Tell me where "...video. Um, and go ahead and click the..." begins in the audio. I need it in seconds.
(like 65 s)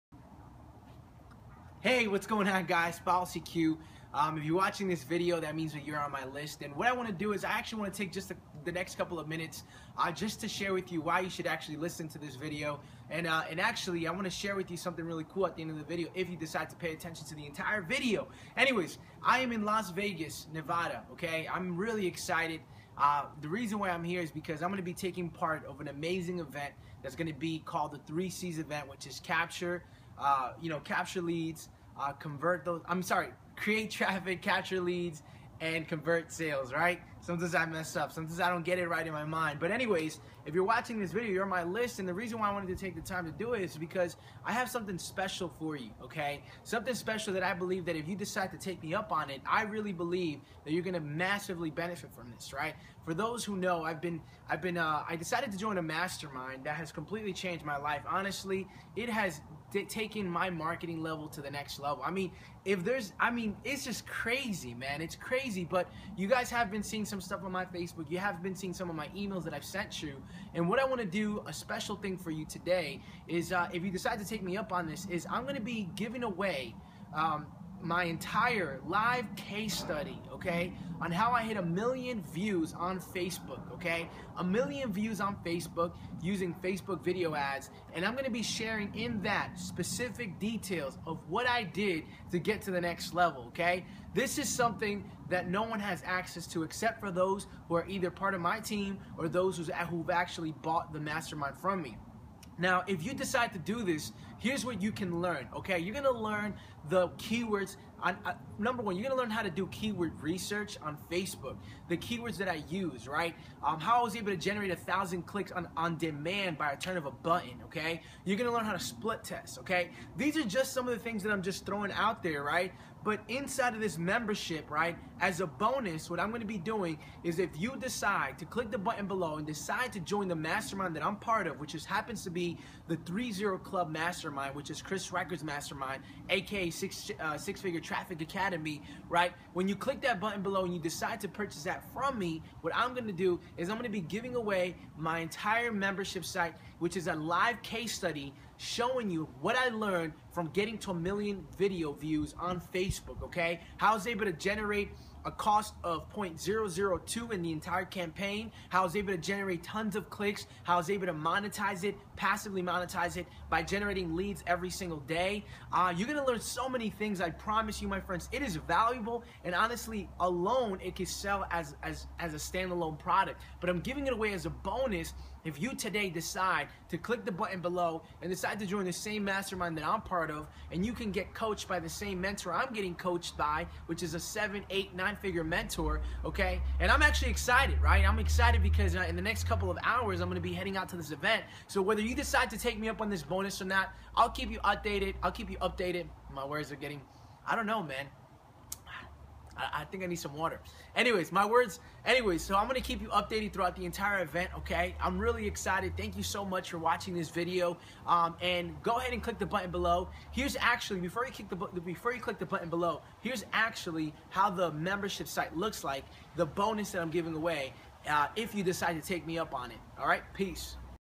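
207 s.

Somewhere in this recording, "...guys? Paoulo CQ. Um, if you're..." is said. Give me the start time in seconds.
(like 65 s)
2 s.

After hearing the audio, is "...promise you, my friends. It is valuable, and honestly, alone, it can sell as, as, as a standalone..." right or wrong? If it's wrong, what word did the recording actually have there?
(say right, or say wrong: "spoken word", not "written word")
right.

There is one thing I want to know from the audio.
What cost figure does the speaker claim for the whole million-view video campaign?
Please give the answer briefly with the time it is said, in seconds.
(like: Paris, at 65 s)
0.002, at 156 s.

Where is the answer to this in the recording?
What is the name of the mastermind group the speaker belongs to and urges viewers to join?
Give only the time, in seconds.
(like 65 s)
132 s.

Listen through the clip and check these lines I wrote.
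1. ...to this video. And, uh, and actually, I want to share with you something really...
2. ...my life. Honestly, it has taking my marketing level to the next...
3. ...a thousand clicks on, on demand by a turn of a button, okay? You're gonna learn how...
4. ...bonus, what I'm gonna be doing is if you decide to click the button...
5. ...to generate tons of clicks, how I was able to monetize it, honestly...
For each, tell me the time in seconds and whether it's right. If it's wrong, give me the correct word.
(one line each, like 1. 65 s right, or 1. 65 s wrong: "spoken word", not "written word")
1. 12 s right
2. 57 s right
3. 114 s right
4. 125 s right
5. 159 s wrong: "passively", not "honestly".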